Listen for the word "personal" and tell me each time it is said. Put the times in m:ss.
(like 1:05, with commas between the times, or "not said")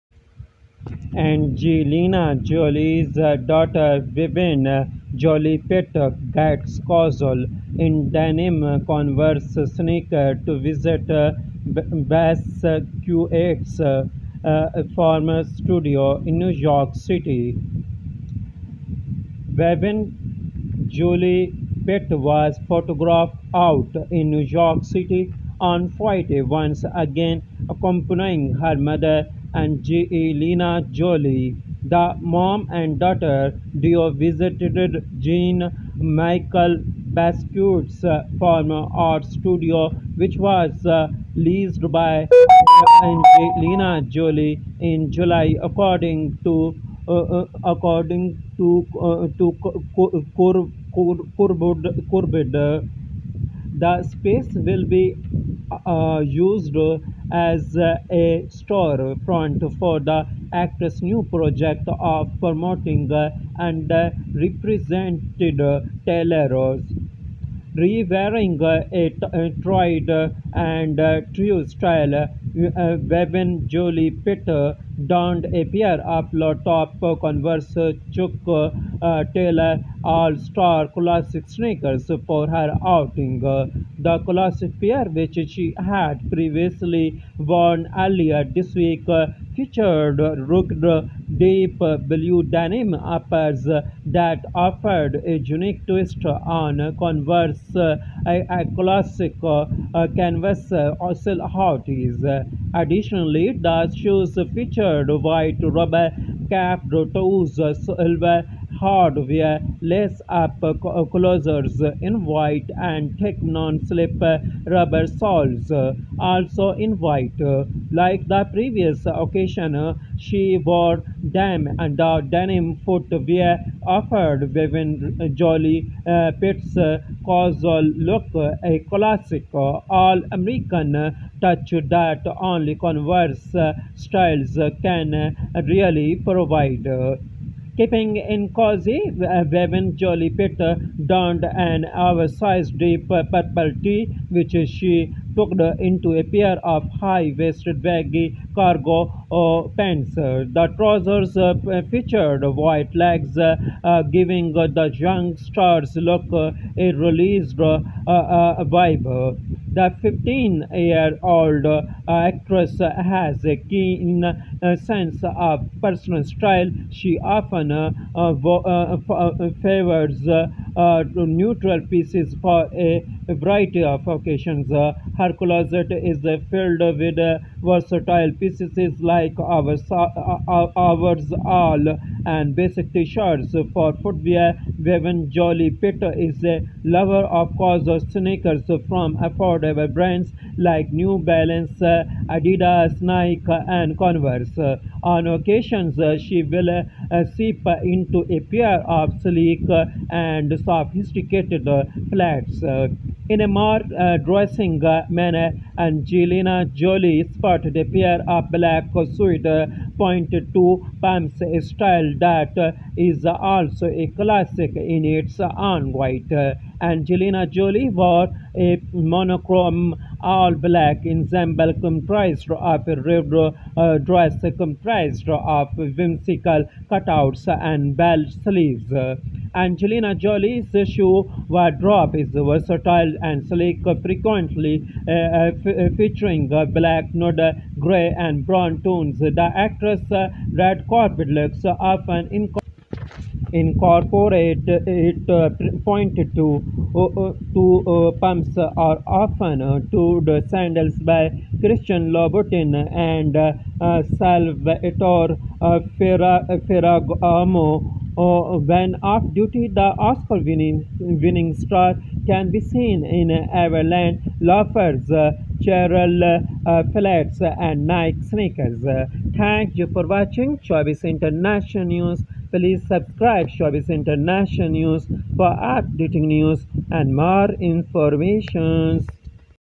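2:45.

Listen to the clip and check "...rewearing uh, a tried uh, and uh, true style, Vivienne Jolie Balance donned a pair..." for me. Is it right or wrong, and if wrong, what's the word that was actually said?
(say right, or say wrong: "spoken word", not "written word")
wrong: "Peter", not "Balance".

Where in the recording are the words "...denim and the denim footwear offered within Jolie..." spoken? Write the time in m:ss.
2:01.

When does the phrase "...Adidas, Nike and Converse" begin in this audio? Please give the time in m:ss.
3:11.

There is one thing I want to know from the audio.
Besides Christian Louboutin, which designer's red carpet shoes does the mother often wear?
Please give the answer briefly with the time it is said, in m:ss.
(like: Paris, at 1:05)
Salvatore Ferragamo, at 4:14.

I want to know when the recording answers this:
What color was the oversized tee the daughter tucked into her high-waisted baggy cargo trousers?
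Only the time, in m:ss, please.
2:22.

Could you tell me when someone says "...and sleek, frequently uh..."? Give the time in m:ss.
3:53.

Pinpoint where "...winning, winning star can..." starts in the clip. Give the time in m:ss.
4:20.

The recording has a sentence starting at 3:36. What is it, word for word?
Angelina Jolie wore a monochrome all black ensemble comprised of a ribbed uh, dress comprised of whimsical cutouts and bell sleeves.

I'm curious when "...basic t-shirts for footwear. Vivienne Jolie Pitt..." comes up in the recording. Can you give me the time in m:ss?
3:02.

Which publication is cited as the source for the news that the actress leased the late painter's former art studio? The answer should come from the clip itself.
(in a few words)
Curbed.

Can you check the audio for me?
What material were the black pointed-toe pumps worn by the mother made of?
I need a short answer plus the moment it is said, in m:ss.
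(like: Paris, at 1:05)
Suede, at 3:29.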